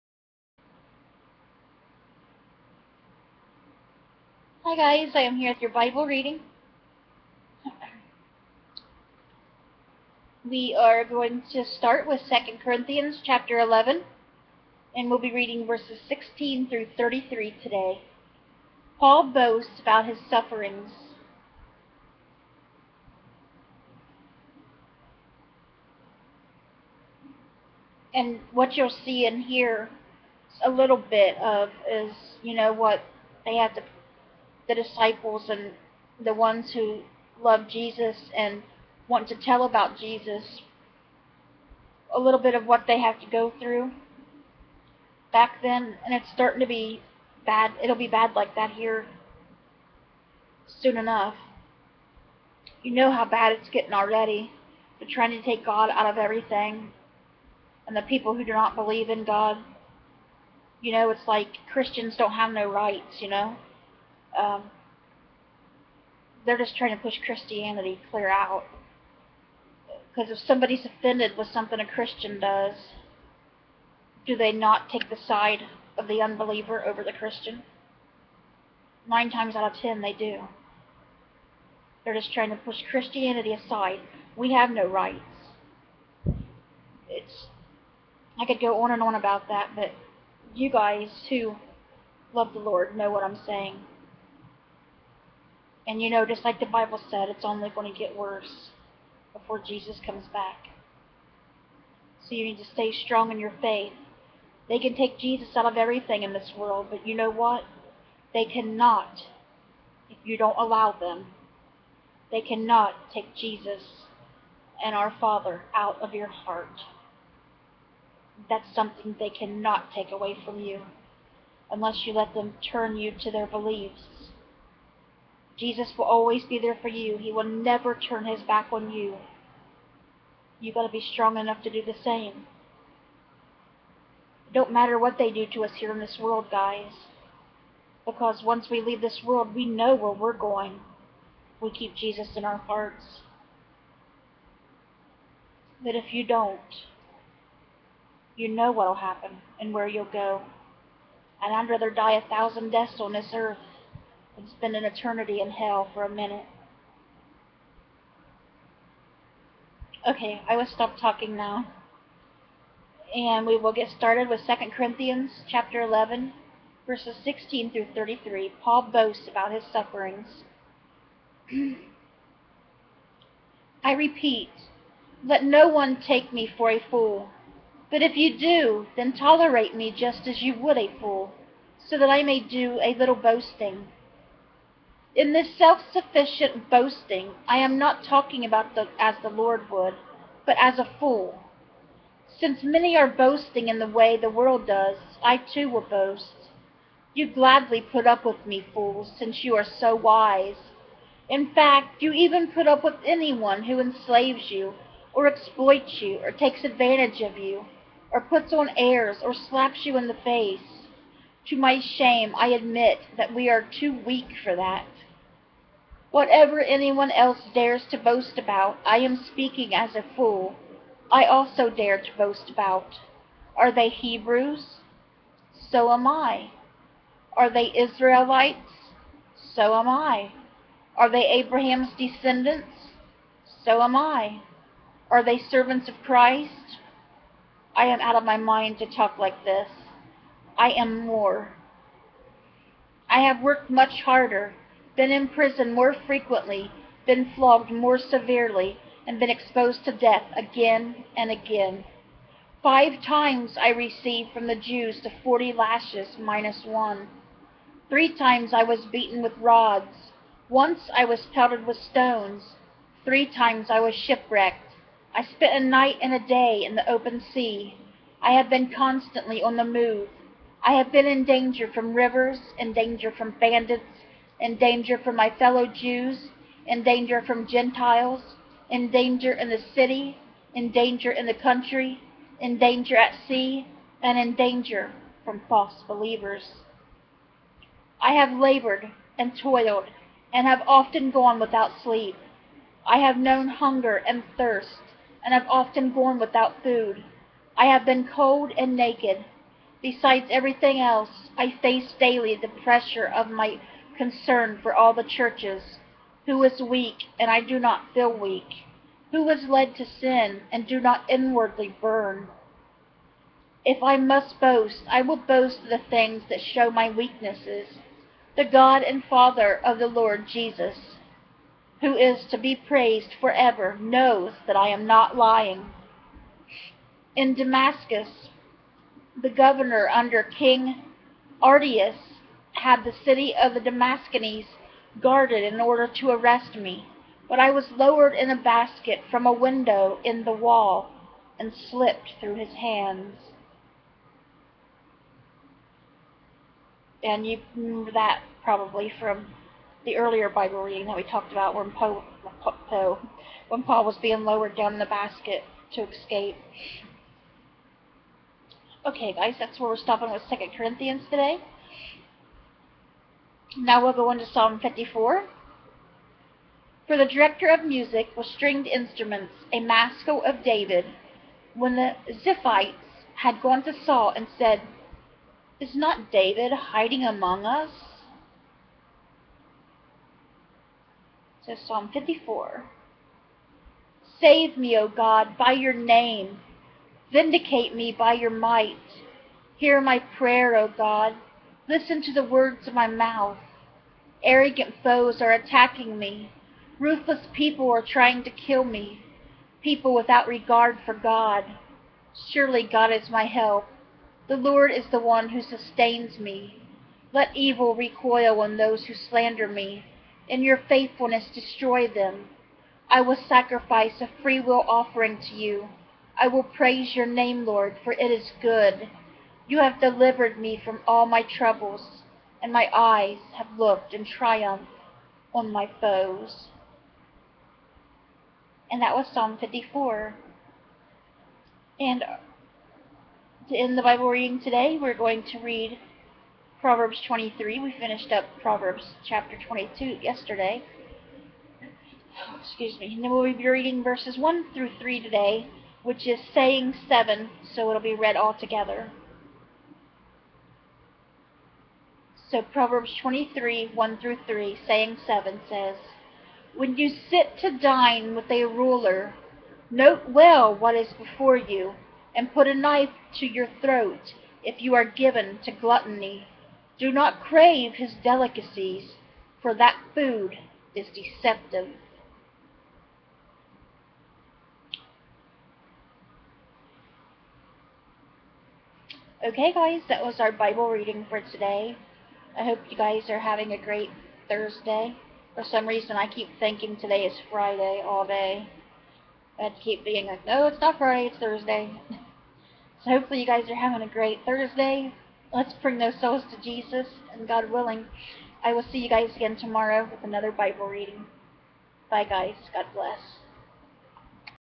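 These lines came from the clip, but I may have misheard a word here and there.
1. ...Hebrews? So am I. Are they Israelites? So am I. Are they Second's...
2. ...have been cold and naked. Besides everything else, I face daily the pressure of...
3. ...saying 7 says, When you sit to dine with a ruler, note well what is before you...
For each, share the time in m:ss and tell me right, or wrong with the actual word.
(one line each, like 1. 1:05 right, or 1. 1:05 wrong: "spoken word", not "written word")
1. 3:43 wrong: "Abraham", not "Second"
2. 4:57 right
3. 7:34 right.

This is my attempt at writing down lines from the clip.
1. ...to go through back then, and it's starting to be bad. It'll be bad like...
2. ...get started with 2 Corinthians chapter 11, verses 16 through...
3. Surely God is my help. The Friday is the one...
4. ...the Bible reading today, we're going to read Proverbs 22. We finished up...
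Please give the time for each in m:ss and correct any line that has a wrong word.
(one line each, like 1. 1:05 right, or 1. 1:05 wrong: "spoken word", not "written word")
1. 0:43 right
2. 2:43 right
3. 6:42 wrong: "Lord", not "Friday"
4. 7:13 wrong: "23", not "22".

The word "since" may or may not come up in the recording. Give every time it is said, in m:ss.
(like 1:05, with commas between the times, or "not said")
3:12, 3:19.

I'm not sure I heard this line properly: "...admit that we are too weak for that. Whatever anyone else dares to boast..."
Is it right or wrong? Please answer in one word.
right.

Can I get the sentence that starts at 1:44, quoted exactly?
They can take Jesus out of everything in this world, but you know what?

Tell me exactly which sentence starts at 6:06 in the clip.
For the director of music was stringed instruments, a maskil of David.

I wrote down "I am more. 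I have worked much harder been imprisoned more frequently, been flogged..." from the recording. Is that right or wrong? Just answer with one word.
right.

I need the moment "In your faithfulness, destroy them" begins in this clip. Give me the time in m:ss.
6:50.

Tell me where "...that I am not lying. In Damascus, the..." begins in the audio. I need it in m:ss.
5:24.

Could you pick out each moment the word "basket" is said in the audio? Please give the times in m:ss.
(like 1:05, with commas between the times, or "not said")
5:38, 5:54.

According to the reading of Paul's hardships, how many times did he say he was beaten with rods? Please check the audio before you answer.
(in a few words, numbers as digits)
3.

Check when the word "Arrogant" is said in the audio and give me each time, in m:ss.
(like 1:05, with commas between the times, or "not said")
6:34.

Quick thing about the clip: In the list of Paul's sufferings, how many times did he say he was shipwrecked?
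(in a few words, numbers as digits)
3.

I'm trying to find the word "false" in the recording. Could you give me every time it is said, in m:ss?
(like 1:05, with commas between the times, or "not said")
4:45.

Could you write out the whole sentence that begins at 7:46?
Do not crave his delicacies, for that food is deceptive.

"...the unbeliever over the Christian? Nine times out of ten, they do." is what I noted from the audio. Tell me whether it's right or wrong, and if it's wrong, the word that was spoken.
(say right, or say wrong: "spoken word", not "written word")
right.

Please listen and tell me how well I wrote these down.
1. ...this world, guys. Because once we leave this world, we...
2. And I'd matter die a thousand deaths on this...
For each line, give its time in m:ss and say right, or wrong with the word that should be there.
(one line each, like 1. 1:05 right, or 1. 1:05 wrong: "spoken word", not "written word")
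1. 2:15 right
2. 2:31 wrong: "rather", not "matter".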